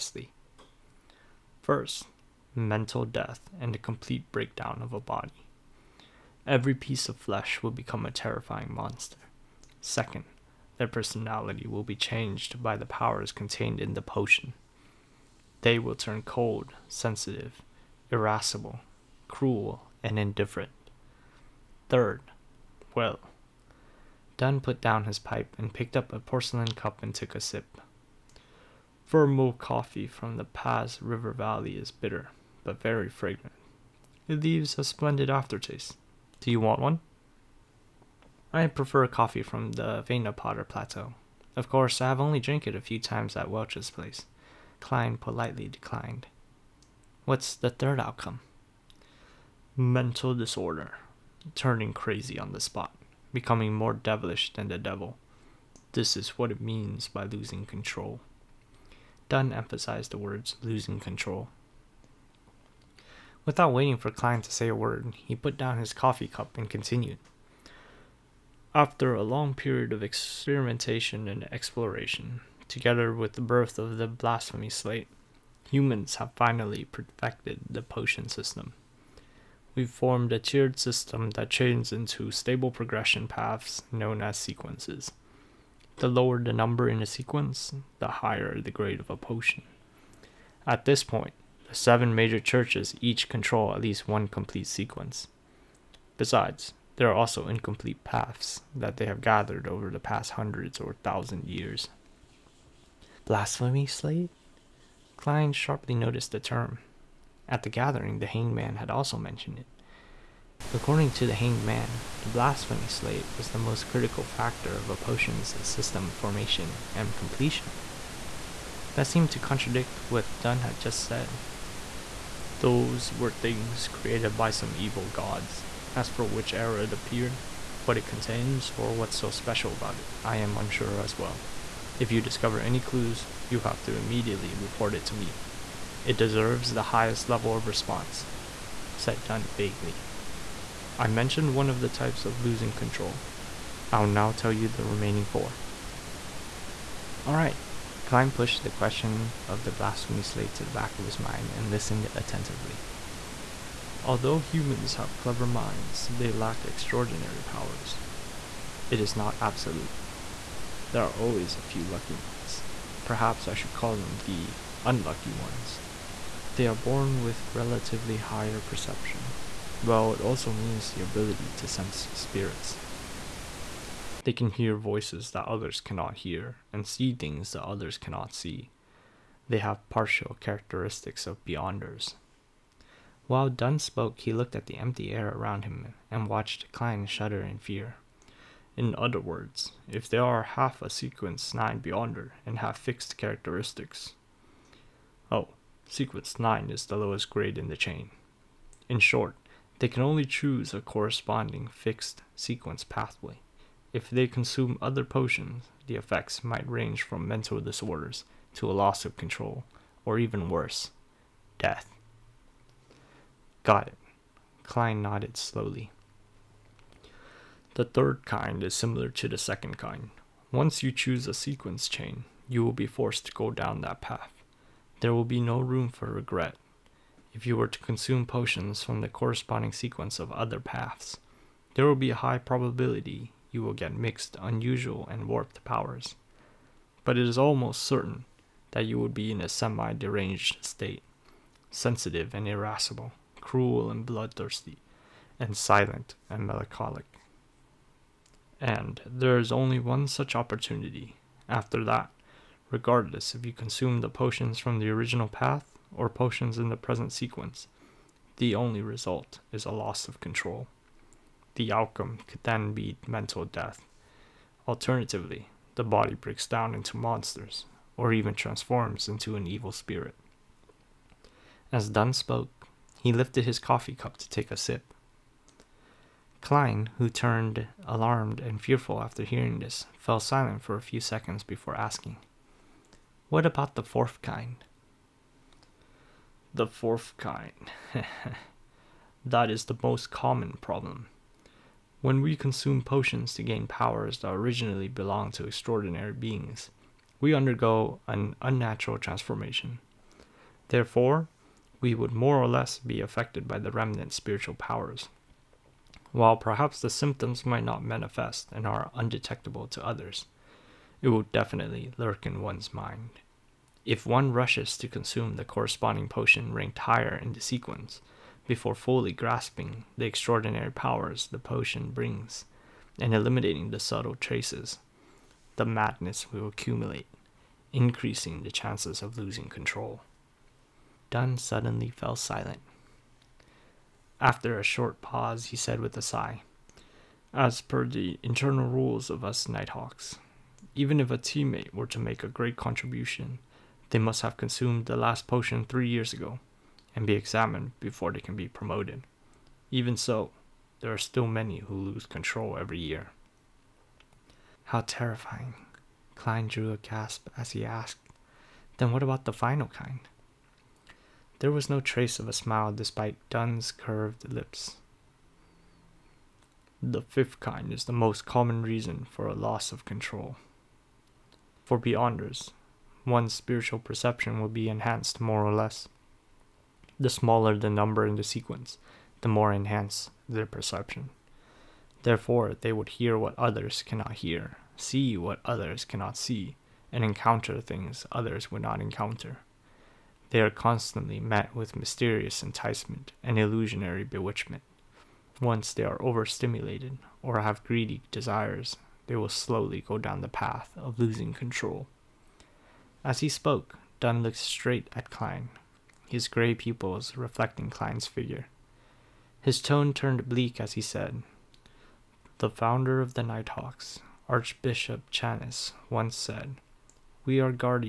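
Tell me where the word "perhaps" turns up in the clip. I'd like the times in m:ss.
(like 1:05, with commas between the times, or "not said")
2:43, 5:06.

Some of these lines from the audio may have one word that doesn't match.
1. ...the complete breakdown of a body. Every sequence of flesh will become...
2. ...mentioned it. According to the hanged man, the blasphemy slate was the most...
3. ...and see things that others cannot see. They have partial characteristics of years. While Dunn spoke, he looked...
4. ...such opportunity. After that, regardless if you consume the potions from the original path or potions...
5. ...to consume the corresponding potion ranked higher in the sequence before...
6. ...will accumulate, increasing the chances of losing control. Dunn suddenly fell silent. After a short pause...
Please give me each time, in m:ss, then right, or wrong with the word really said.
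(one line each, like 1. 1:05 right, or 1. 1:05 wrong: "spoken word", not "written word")
1. 0:03 wrong: "piece", not "sequence"
2. 1:49 right
3. 2:56 wrong: "beyonders", not "years"
4. 4:10 right
5. 5:14 right
6. 5:26 right.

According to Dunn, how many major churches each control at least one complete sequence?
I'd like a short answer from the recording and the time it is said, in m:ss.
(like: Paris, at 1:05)
7, at 1:31.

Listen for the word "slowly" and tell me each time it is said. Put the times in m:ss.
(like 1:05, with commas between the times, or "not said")
3:35, 6:39.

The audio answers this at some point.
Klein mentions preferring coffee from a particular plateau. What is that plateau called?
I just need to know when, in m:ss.
0:40.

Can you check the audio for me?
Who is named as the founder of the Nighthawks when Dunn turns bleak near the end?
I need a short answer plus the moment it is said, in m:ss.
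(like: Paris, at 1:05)
Archbishop Chanis, at 6:54.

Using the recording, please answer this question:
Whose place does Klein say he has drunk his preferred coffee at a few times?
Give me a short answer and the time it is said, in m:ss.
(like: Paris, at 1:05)
Welch, at 0:43.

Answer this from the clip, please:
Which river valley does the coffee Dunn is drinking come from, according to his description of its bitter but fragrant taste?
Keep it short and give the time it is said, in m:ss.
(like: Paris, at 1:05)
Paz River Valley, at 0:30.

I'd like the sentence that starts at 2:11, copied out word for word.
If you discover any clues, you have to immediately report it to me.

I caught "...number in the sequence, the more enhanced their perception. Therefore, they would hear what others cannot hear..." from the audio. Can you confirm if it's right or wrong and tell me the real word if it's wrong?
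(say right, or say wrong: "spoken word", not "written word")
right.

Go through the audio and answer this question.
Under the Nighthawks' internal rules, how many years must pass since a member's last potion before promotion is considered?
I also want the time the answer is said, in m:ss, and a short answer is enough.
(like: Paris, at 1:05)
3, at 5:45.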